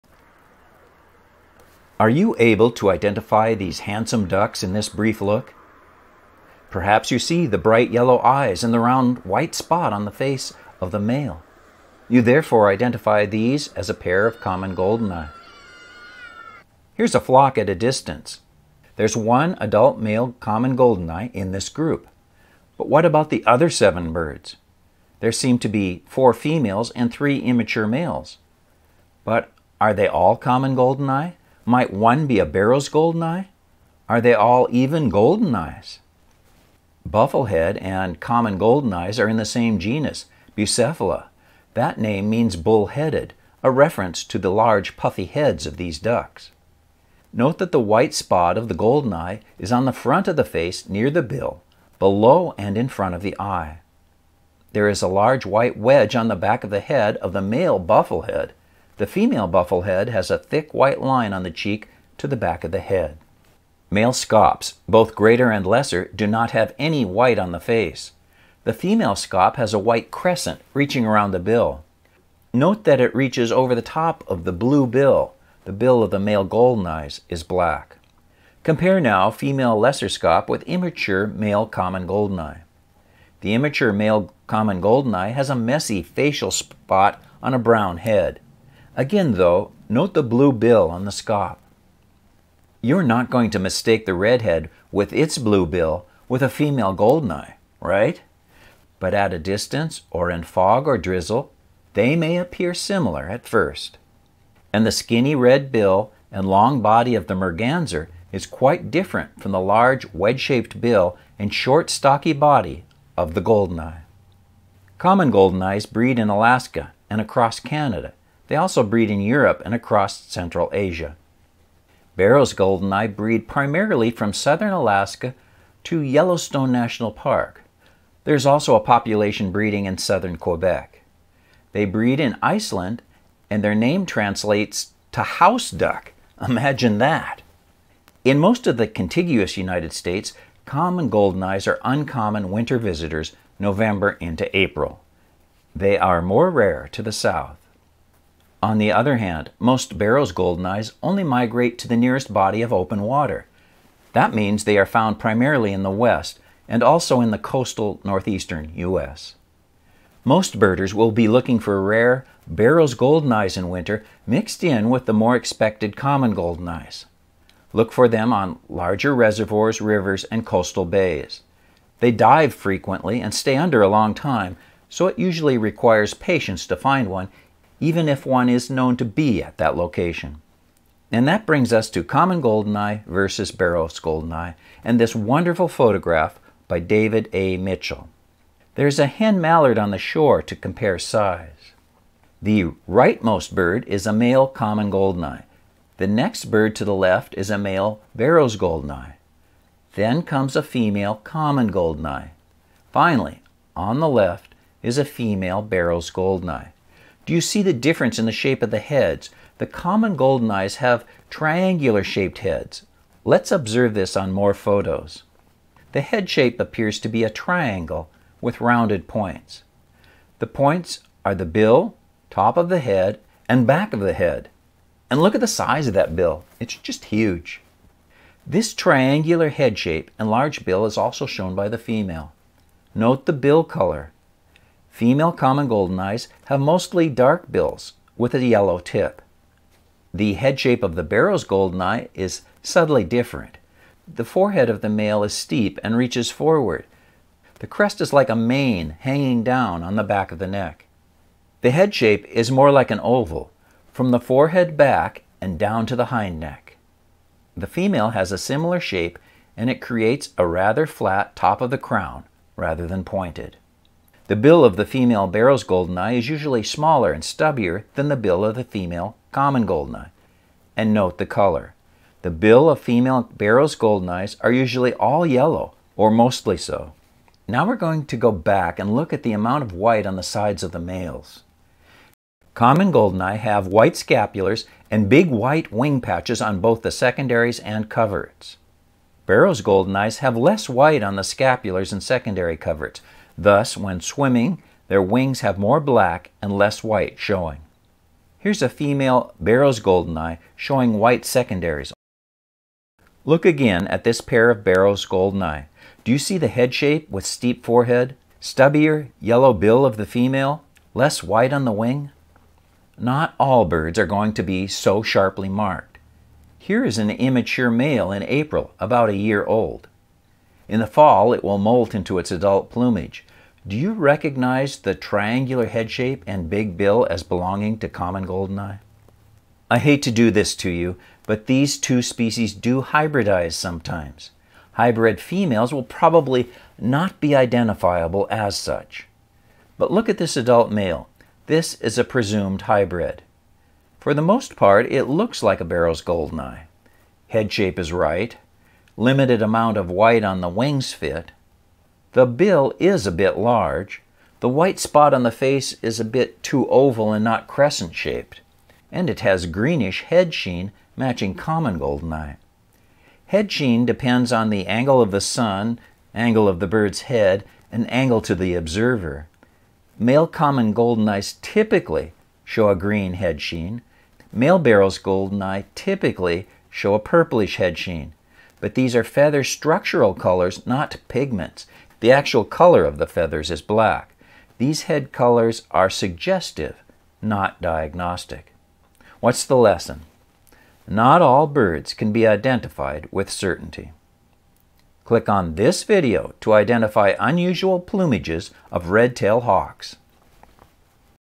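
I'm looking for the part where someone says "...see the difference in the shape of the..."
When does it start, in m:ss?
3:27.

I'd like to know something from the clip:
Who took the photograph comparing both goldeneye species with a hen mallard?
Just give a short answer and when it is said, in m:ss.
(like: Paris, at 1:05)
David A. Mitchell, at 3:06.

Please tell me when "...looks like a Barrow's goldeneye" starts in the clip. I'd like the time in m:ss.
5:45.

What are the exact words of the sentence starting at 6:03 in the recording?
Head sheen depends on the angle of the sun, angle of the bird's head, and angle to the observer.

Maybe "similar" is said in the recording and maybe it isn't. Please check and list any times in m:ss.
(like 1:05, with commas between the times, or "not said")
1:42, 4:18.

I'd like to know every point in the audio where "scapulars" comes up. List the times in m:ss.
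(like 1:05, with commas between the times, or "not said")
4:43, 4:51.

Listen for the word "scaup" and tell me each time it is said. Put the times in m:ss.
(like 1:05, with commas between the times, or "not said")
1:04, 1:09, 1:20, 1:31.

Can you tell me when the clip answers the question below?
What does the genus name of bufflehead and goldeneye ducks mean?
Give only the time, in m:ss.
0:42.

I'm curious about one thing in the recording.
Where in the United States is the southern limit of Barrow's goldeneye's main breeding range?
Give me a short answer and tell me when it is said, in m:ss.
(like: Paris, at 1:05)
Yellowstone National Park, at 2:06.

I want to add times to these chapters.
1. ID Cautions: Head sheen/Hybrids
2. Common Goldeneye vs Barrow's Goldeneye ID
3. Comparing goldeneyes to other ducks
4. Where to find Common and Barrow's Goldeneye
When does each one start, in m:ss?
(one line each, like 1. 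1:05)
1. 5:29
2. 3:00
3. 0:34
4. 1:54.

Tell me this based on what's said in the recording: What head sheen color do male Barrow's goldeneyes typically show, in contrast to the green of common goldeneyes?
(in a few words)
Purplish.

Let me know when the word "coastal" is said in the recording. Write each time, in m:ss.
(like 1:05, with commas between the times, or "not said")
2:37, 2:50.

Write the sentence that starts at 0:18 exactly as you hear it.
There's one adult male common goldeneye in this group.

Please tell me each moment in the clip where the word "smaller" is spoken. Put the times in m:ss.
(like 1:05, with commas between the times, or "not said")
4:26.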